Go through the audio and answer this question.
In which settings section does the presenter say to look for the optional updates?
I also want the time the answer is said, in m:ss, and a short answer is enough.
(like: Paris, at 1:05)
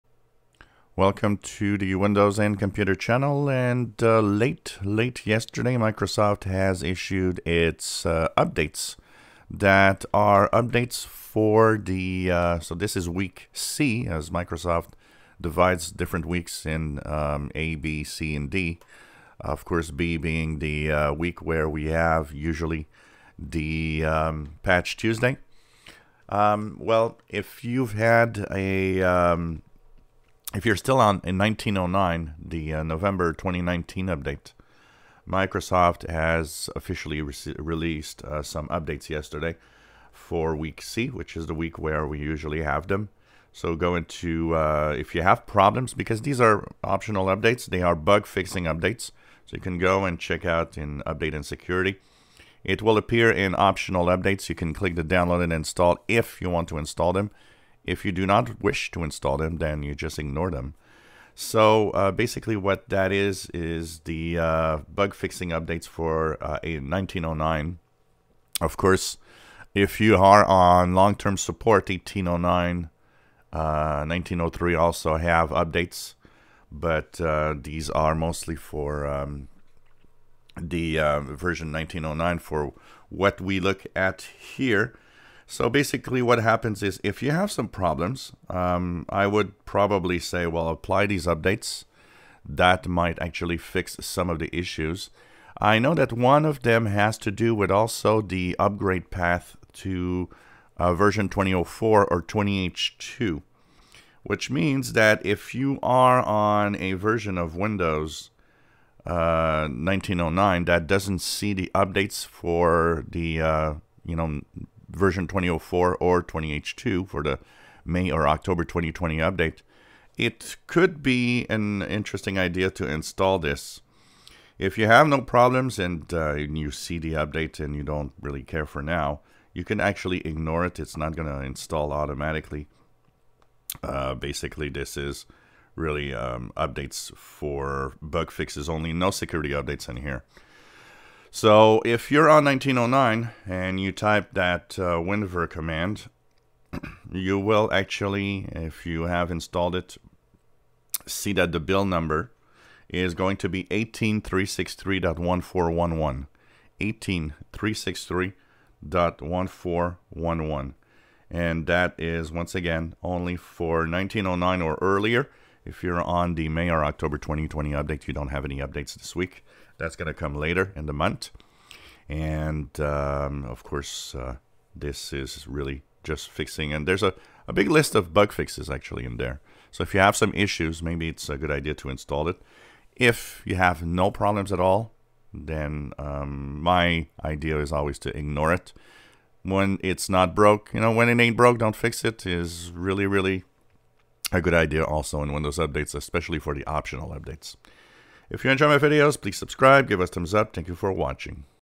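update and security, at 0:51.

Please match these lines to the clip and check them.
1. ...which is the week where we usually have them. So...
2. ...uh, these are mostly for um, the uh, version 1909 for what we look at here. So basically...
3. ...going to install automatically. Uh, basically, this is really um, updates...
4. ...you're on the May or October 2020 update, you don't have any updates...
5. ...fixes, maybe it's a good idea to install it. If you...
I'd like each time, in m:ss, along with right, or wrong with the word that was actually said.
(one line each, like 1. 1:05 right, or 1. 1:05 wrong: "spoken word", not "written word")
1. 0:41 right
2. 1:17 right
3. 2:11 right
4. 2:45 right
5. 3:00 wrong: "issues", not "fixes".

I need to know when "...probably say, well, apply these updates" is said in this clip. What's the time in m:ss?
1:29.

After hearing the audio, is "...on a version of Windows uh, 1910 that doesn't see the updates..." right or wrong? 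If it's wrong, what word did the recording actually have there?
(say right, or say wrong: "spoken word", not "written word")
wrong: "1909", not "1910".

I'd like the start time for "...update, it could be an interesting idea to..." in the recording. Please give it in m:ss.
1:59.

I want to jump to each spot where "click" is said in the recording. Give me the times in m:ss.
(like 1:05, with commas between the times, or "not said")
0:54.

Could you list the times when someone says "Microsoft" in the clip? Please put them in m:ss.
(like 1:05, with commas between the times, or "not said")
0:05, 0:14, 0:35.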